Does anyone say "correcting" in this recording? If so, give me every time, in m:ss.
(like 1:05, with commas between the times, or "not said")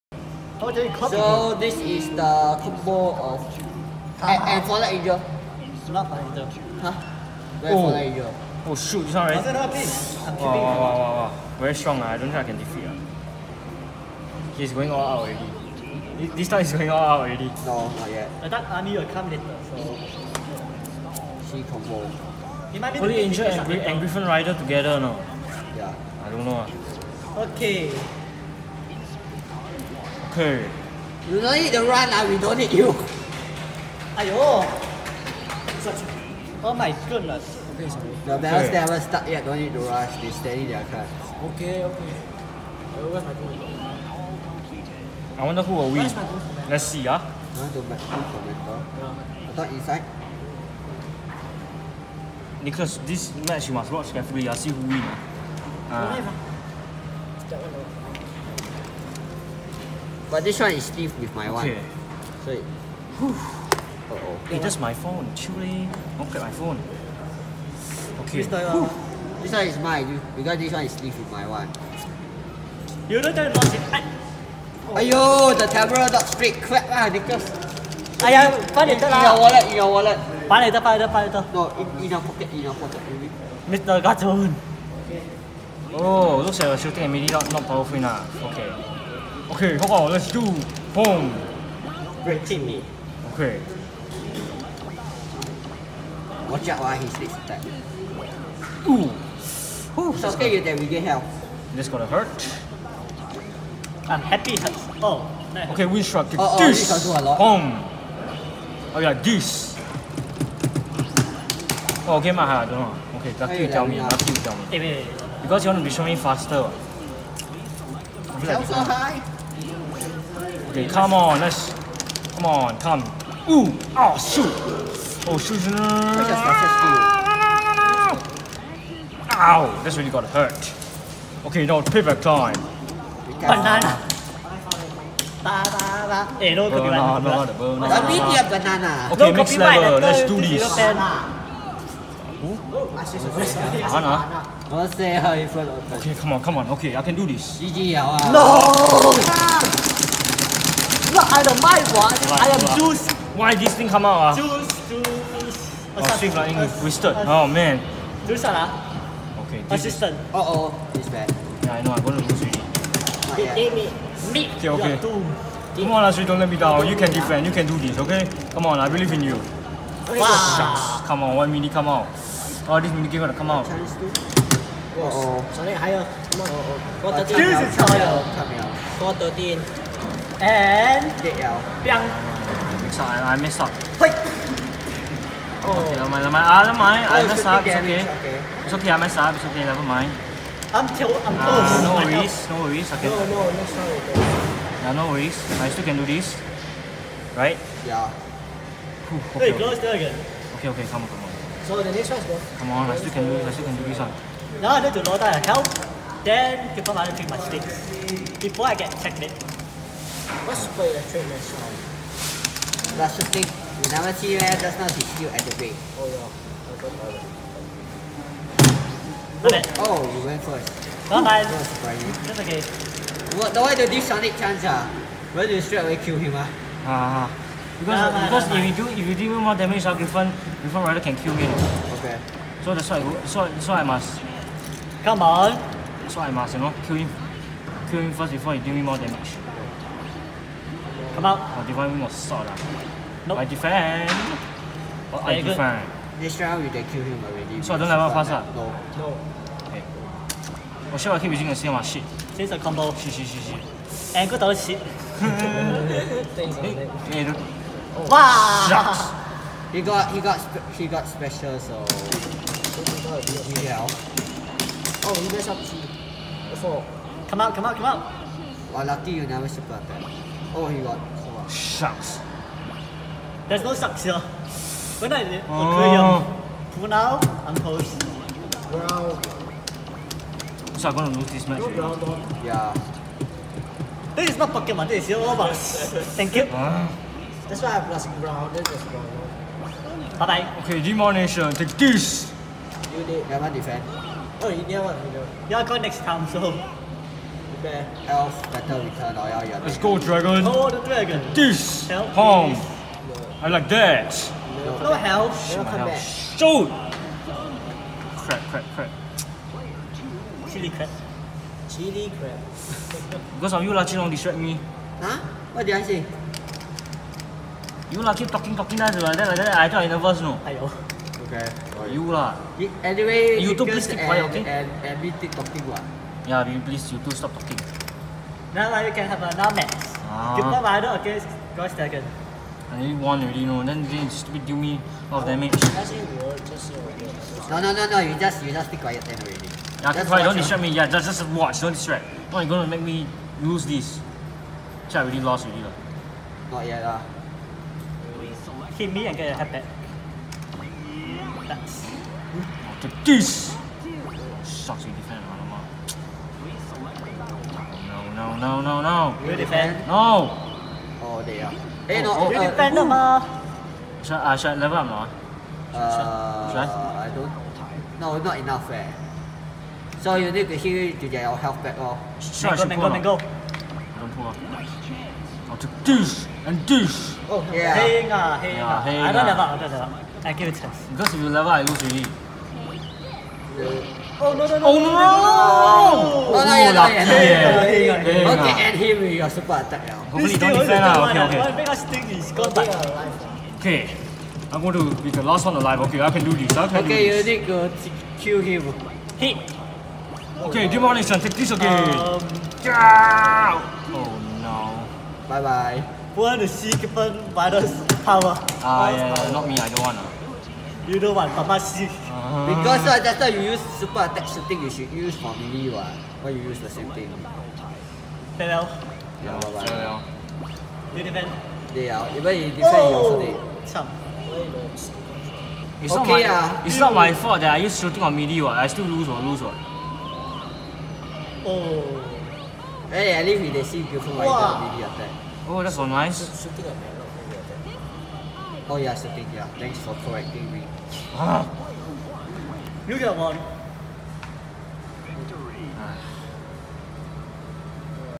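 7:20.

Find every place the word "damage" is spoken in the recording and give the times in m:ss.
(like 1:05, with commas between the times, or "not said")
3:49, 3:59, 5:35.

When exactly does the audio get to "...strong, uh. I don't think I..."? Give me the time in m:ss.
0:11.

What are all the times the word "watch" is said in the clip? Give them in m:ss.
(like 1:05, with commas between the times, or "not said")
0:53, 1:36, 5:41.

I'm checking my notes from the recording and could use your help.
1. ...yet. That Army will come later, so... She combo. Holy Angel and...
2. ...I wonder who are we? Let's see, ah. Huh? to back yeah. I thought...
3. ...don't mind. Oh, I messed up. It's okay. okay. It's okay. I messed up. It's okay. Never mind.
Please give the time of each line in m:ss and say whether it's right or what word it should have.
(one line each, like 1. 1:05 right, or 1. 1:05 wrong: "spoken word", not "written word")
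1. 0:18 right
2. 0:45 right
3. 3:06 right.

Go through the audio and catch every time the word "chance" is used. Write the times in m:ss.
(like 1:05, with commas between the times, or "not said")
3:44, 6:14.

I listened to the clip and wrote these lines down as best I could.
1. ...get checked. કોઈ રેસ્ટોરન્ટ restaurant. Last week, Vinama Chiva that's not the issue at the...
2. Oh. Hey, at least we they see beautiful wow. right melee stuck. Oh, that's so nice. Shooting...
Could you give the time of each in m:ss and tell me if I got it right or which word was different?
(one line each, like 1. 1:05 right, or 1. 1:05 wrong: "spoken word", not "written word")
1. 3:28 right
2. 7:11 wrong: "attack", not "stuck".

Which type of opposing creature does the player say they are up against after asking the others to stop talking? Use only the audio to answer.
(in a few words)
Ghost Dragon.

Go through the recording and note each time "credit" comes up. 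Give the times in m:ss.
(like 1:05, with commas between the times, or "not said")
not said.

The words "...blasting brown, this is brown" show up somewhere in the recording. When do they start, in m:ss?
4:47.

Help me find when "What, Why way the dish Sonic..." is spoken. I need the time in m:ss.
3:43.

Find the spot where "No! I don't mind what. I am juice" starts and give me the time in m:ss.
2:27.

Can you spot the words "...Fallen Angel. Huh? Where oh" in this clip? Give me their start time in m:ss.
0:06.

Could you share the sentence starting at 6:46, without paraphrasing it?
Who want to see given by power?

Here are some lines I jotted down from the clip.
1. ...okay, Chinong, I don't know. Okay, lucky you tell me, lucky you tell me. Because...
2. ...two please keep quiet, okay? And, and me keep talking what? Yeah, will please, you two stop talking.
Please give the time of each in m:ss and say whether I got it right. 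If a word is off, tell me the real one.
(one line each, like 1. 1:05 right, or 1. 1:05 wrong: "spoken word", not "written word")
1. 1:52 wrong: "Maha", not "Chinong"
2. 5:23 right.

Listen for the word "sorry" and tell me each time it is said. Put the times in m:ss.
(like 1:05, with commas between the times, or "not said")
0:37, 2:55, 3:13.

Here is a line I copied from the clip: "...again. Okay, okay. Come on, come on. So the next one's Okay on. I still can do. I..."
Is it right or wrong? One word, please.
wrong.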